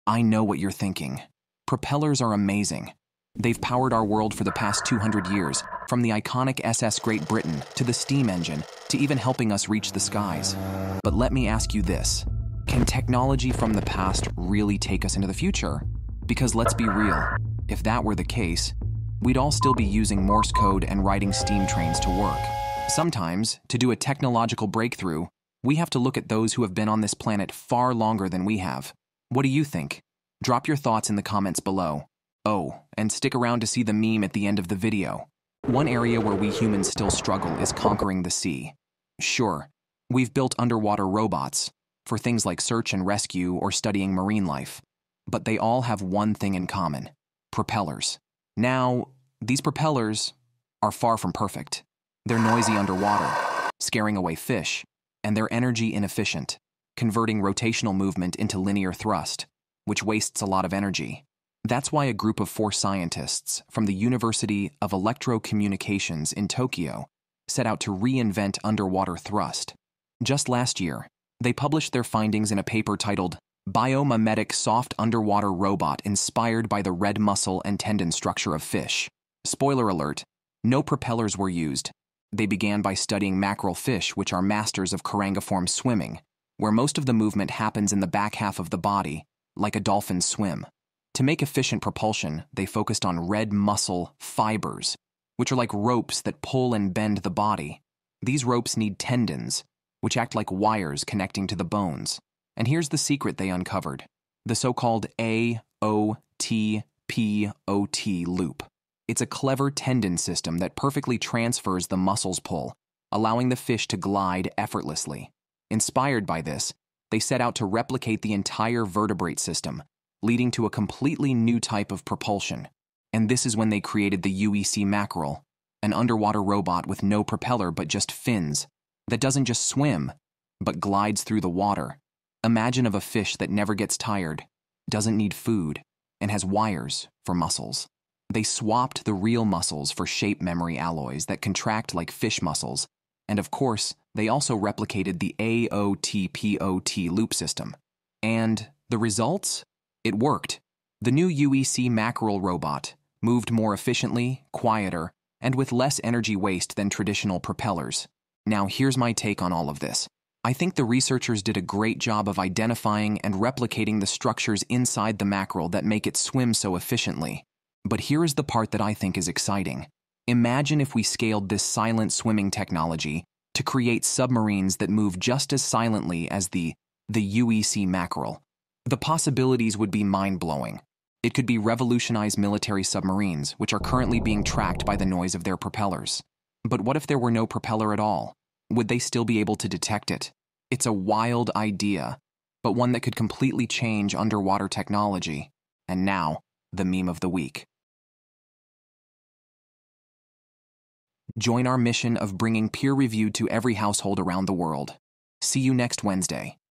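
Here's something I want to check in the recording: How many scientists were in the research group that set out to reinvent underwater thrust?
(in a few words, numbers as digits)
4.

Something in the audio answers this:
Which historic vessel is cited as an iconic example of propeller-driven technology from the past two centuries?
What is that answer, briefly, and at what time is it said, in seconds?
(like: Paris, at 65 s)
SS Great Britain, at 6 s.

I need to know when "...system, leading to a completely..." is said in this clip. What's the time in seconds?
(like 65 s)
119 s.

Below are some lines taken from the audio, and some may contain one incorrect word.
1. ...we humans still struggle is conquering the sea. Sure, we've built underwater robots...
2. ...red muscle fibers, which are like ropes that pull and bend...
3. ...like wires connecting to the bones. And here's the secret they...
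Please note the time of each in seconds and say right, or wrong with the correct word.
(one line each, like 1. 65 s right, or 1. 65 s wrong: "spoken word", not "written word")
1. 36 s right
2. 93 s right
3. 100 s right.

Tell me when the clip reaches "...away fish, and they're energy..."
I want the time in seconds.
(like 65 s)
54 s.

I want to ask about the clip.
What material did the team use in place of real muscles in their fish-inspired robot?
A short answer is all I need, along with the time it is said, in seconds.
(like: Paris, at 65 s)
Shape memory alloys, at 140 s.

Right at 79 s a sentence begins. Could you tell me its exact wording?
Spoiler alert, no propellers were used.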